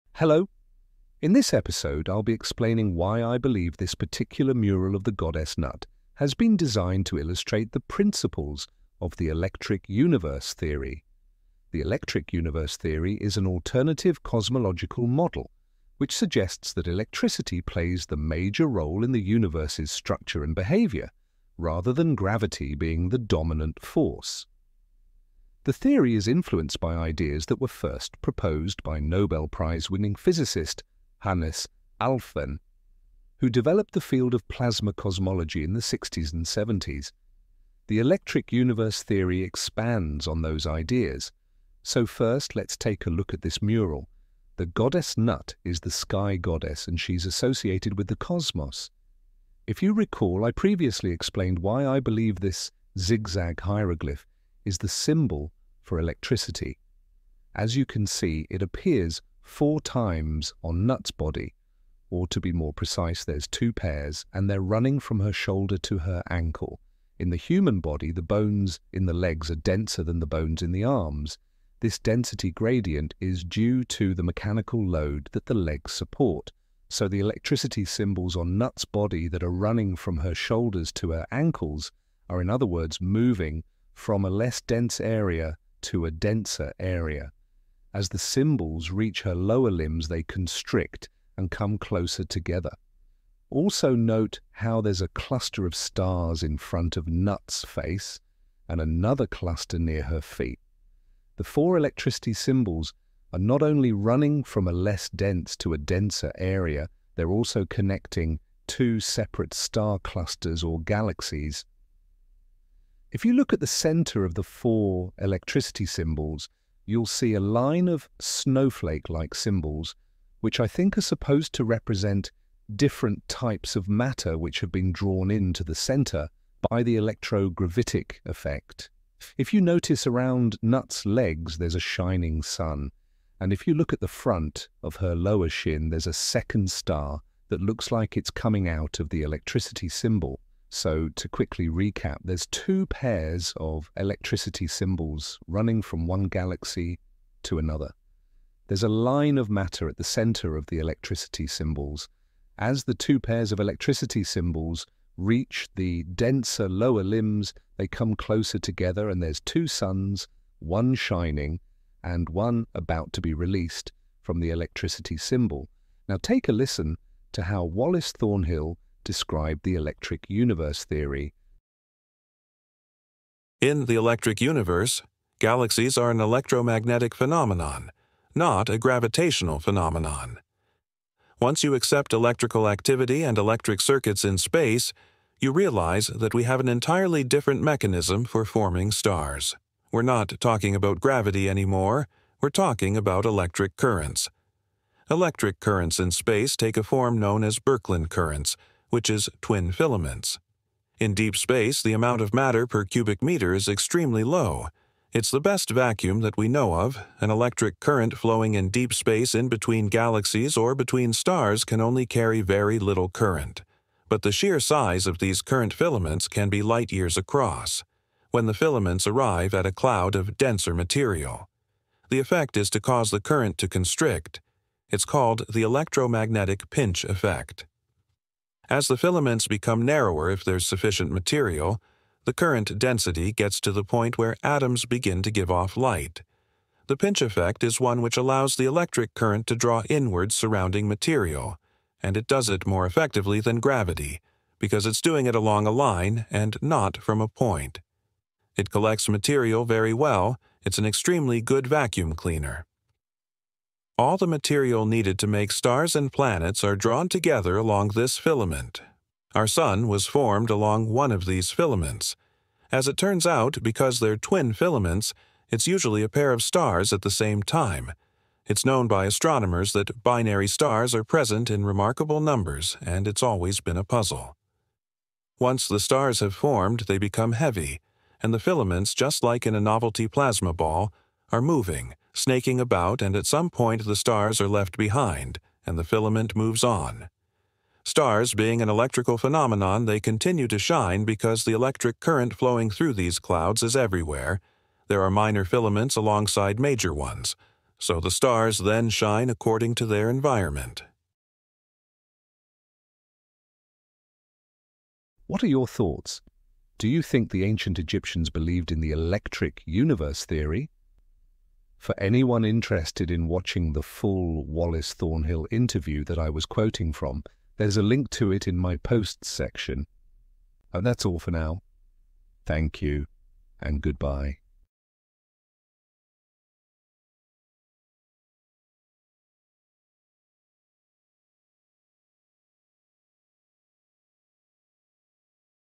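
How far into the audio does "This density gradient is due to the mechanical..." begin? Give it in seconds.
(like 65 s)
71 s.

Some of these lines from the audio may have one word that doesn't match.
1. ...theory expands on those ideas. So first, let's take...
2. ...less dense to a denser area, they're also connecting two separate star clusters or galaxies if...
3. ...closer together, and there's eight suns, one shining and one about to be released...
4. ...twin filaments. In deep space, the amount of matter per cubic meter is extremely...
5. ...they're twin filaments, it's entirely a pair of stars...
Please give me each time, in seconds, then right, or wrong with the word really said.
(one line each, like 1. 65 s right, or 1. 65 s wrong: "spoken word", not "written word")
1. 39 s right
2. 104 s right
3. 158 s wrong: "two", not "eight"
4. 199 s right
5. 263 s wrong: "usually", not "entirely".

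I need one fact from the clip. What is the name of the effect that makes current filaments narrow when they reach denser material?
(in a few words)
electromagnetic pinch effect.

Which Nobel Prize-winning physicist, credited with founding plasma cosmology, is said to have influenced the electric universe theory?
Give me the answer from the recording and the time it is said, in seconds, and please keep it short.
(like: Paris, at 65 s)
Hannes Alfven, at 31 s.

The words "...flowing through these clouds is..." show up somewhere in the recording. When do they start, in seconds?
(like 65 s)
292 s.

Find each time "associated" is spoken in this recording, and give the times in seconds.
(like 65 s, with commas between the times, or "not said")
47 s.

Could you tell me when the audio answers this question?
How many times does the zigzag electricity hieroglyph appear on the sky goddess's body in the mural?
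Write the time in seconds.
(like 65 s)
59 s.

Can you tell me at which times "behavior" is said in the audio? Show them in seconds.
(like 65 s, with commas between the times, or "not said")
20 s.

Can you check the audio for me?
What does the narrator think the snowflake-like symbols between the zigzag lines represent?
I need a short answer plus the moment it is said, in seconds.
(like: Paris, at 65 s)
different types of matter, at 122 s.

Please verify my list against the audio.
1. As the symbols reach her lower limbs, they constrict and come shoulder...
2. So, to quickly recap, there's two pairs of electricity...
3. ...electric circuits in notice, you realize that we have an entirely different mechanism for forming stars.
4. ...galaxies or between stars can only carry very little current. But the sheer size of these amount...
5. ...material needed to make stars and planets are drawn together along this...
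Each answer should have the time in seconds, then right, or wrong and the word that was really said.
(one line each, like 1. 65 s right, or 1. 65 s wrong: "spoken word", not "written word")
1. 87 s wrong: "closer", not "shoulder"
2. 140 s right
3. 183 s wrong: "space", not "notice"
4. 209 s wrong: "current", not "amount"
5. 254 s right.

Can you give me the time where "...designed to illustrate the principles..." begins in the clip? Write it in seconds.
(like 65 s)
6 s.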